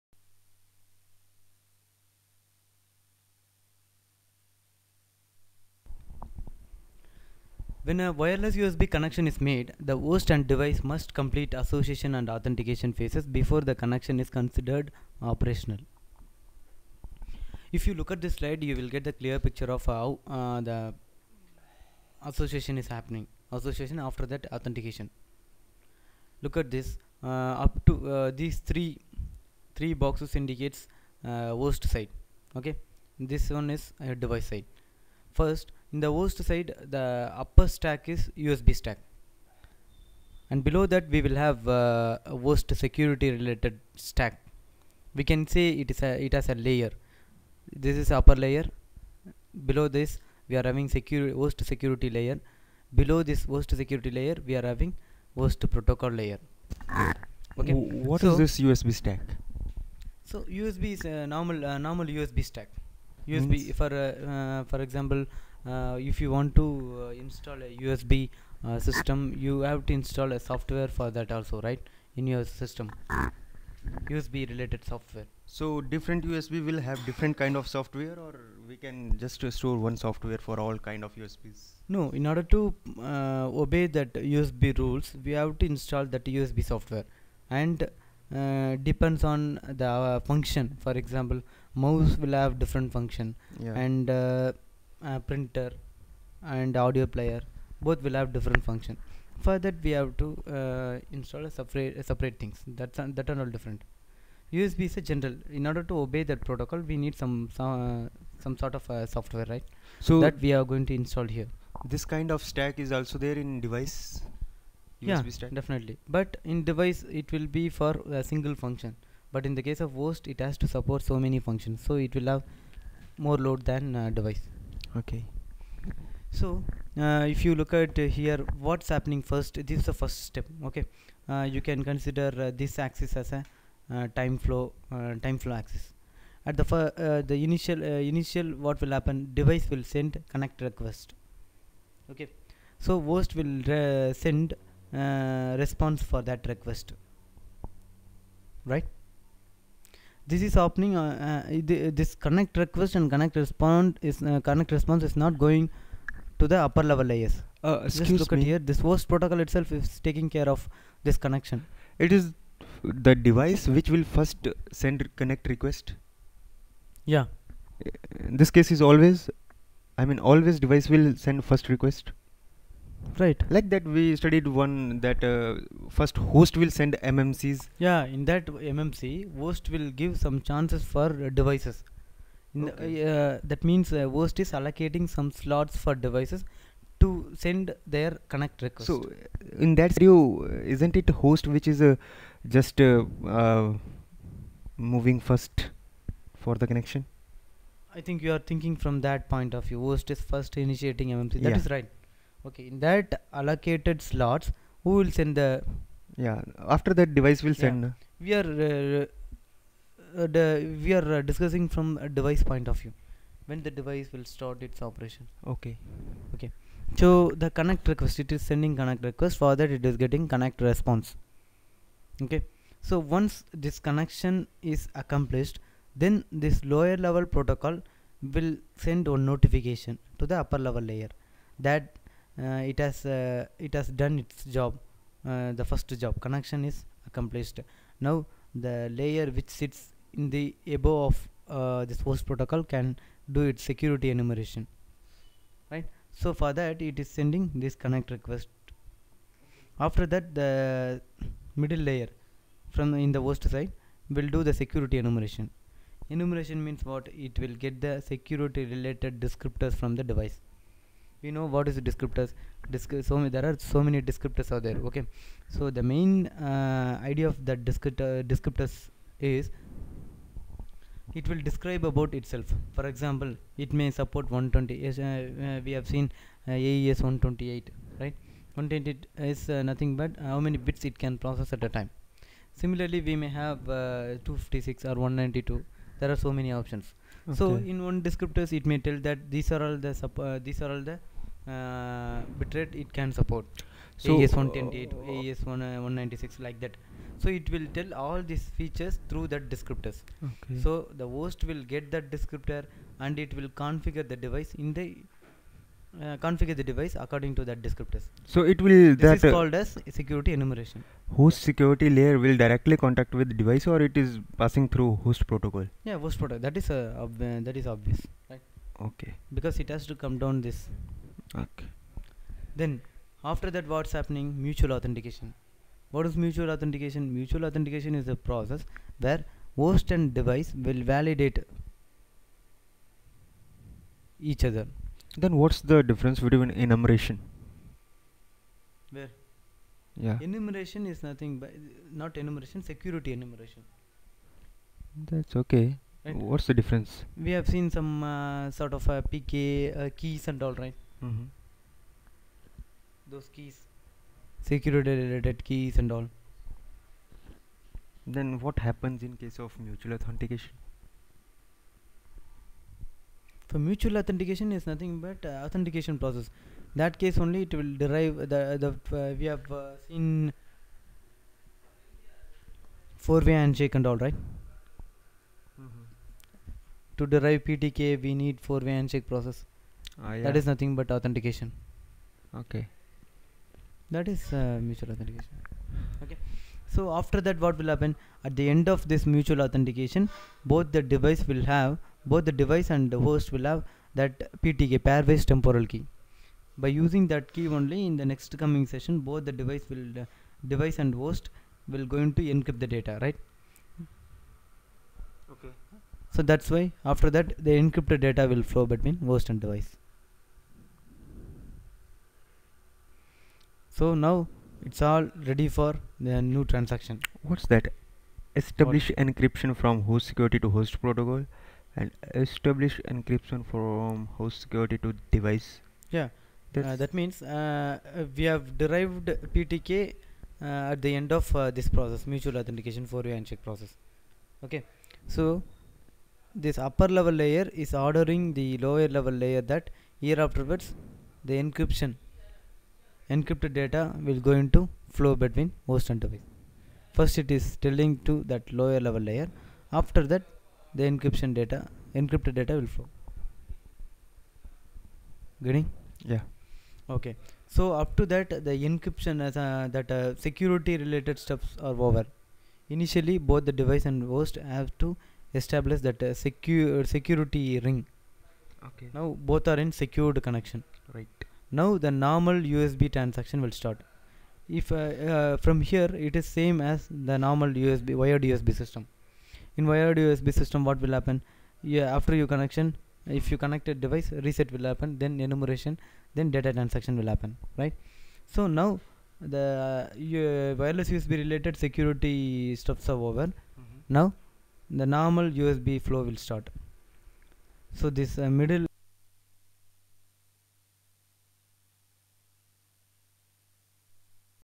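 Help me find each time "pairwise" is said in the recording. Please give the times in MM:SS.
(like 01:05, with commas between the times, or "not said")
06:34.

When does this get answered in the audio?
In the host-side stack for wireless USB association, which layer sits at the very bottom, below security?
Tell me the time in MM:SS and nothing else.
00:55.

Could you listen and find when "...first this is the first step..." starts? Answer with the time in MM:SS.
02:09.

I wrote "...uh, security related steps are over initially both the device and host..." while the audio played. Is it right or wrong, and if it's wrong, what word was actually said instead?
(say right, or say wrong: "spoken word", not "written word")
right.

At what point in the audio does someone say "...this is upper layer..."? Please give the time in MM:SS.
00:47.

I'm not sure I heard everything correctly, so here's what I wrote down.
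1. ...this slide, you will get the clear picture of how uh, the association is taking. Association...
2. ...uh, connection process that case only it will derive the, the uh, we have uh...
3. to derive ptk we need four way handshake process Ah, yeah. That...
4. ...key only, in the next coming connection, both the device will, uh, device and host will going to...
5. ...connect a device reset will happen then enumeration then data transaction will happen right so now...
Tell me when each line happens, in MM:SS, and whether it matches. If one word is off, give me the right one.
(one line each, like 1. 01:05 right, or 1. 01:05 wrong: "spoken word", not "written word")
1. 00:18 wrong: "happening", not "taking"
2. 06:05 wrong: "authentication", not "connection"
3. 06:17 right
4. 06:37 wrong: "session", not "connection"
5. 08:03 right.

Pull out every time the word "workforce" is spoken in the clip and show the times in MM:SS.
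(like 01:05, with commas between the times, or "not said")
not said.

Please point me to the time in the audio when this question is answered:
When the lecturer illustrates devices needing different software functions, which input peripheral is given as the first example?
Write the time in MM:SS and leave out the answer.
01:31.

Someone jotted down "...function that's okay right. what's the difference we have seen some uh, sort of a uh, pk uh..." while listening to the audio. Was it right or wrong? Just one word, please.
wrong.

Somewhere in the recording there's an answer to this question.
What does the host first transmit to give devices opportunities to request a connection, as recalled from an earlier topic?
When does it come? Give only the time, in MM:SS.
02:57.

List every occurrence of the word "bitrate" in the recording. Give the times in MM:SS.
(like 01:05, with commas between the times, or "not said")
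04:52.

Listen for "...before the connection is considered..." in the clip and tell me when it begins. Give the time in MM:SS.
00:13.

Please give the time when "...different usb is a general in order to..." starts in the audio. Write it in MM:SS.
01:43.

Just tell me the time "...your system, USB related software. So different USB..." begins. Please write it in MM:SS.
01:12.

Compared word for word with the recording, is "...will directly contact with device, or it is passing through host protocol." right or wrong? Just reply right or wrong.
right.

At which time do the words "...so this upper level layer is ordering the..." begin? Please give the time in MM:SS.
07:15.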